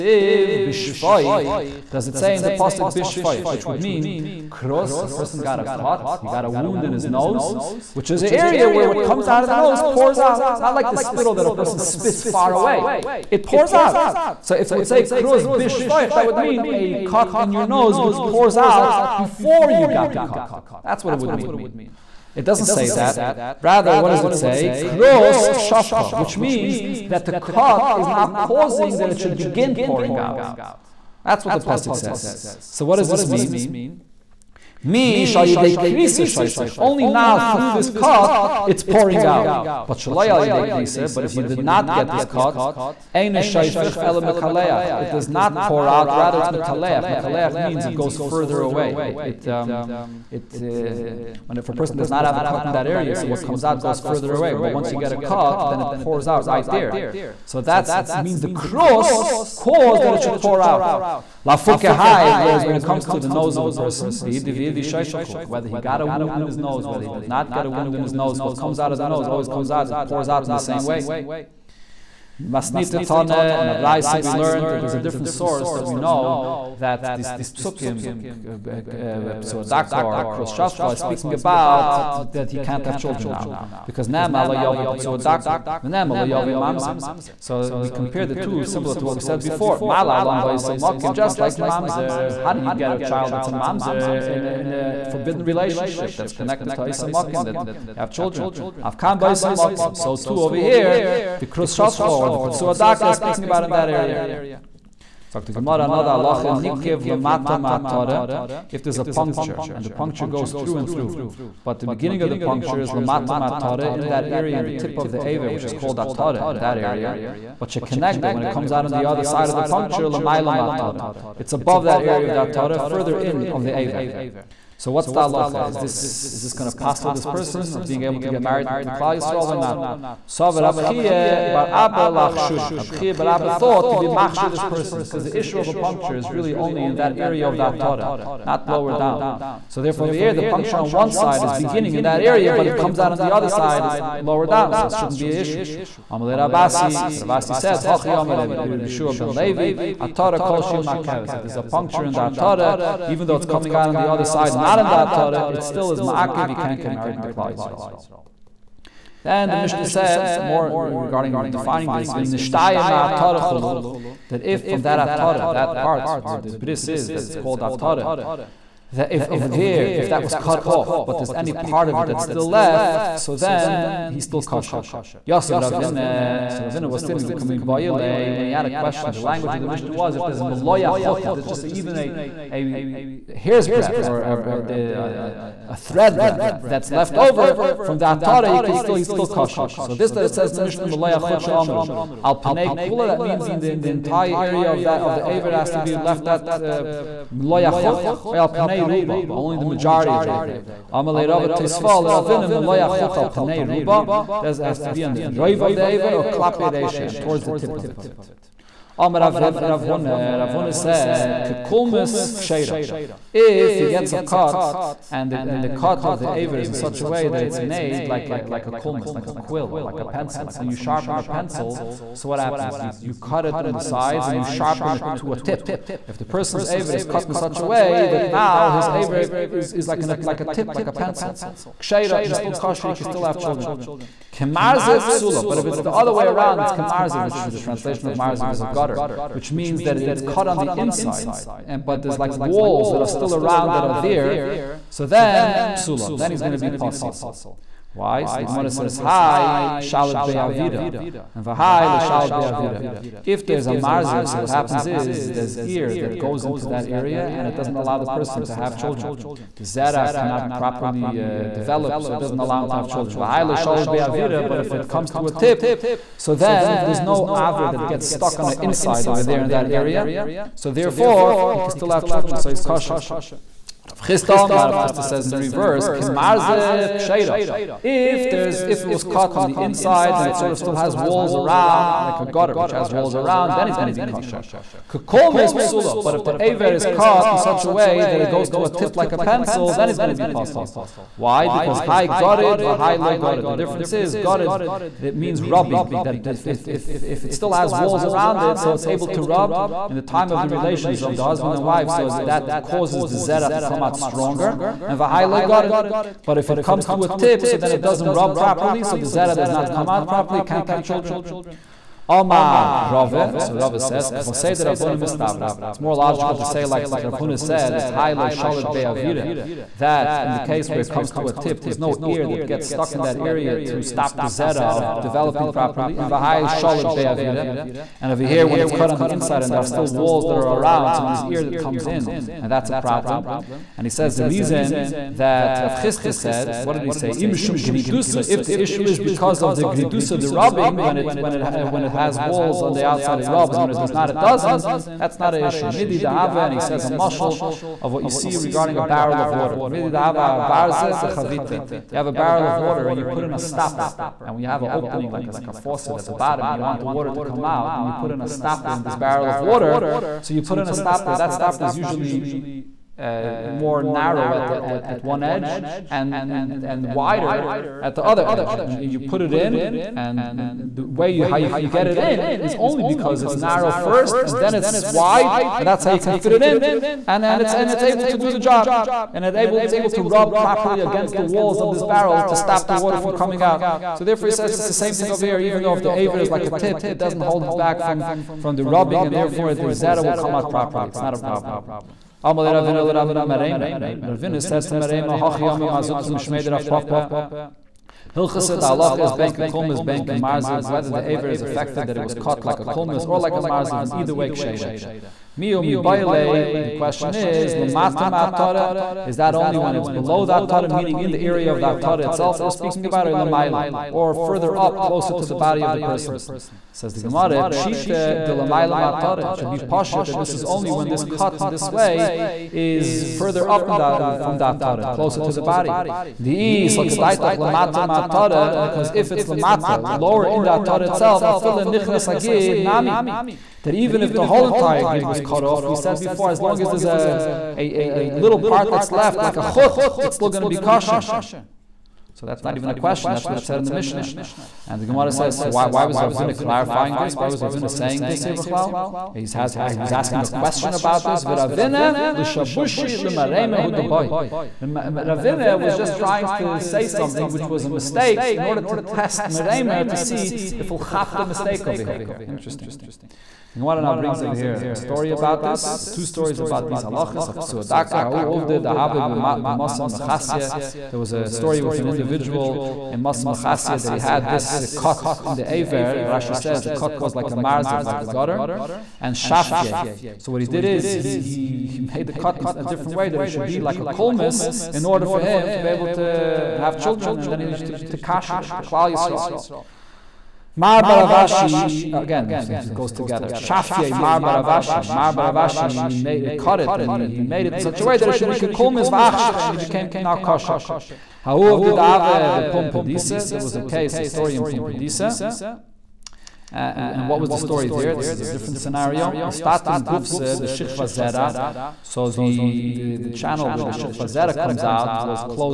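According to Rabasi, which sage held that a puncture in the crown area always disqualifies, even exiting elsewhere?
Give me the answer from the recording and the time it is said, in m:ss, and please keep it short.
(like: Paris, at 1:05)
Yehoshua ben Levi, at 2:28.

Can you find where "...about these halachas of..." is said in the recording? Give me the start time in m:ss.
7:46.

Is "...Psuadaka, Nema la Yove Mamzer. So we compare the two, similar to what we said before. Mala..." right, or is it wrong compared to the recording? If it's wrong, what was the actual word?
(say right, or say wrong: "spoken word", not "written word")
right.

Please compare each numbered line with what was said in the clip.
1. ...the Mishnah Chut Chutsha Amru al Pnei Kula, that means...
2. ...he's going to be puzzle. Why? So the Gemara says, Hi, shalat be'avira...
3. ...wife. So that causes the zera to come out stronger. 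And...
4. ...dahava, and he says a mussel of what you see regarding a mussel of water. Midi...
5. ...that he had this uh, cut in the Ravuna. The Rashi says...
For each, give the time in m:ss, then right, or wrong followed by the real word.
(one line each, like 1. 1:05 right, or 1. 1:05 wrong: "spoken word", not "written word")
1. 3:10 wrong: "Malaya", not "Chut"
2. 4:06 right
3. 5:01 right
4. 5:45 wrong: "barrel", not "mussel"
5. 7:53 wrong: "Aver", not "Ravuna".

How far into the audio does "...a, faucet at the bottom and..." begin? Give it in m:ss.
5:55.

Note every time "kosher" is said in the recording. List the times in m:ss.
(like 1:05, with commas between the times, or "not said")
2:54, 3:09, 3:52, 4:32, 4:44, 7:20, 8:20.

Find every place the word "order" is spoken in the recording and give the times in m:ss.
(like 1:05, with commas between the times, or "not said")
7:38, 8:04.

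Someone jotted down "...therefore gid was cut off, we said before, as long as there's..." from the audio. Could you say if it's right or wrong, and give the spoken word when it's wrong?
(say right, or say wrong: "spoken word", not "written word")
wrong: "entire", not "therefore".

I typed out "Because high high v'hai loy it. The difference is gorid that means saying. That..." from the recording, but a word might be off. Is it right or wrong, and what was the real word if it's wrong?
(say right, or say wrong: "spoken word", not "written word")
wrong: "rubbing", not "saying".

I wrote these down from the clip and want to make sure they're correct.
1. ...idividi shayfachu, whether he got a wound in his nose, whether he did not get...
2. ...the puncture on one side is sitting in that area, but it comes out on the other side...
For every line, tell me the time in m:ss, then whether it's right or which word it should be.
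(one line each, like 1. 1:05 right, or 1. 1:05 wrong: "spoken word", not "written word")
1. 1:04 right
2. 2:20 wrong: "beginning", not "sitting".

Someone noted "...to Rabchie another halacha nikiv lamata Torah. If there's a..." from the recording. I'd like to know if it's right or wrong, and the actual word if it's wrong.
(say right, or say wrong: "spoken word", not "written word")
wrong: "Gemara", not "Rabchie".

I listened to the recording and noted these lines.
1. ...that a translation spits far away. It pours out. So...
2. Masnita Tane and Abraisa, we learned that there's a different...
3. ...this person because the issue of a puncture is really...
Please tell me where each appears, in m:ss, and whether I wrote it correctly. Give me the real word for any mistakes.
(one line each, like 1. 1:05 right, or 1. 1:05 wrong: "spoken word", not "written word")
1. 0:11 wrong: "person", not "translation"
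2. 1:12 right
3. 2:14 right.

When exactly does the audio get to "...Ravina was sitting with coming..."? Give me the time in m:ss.
2:56.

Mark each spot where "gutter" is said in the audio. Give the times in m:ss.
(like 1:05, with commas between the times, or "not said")
3:58, 4:42, 7:58.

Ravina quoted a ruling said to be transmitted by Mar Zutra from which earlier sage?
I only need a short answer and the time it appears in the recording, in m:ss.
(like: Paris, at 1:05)
Rav Papa, at 6:36.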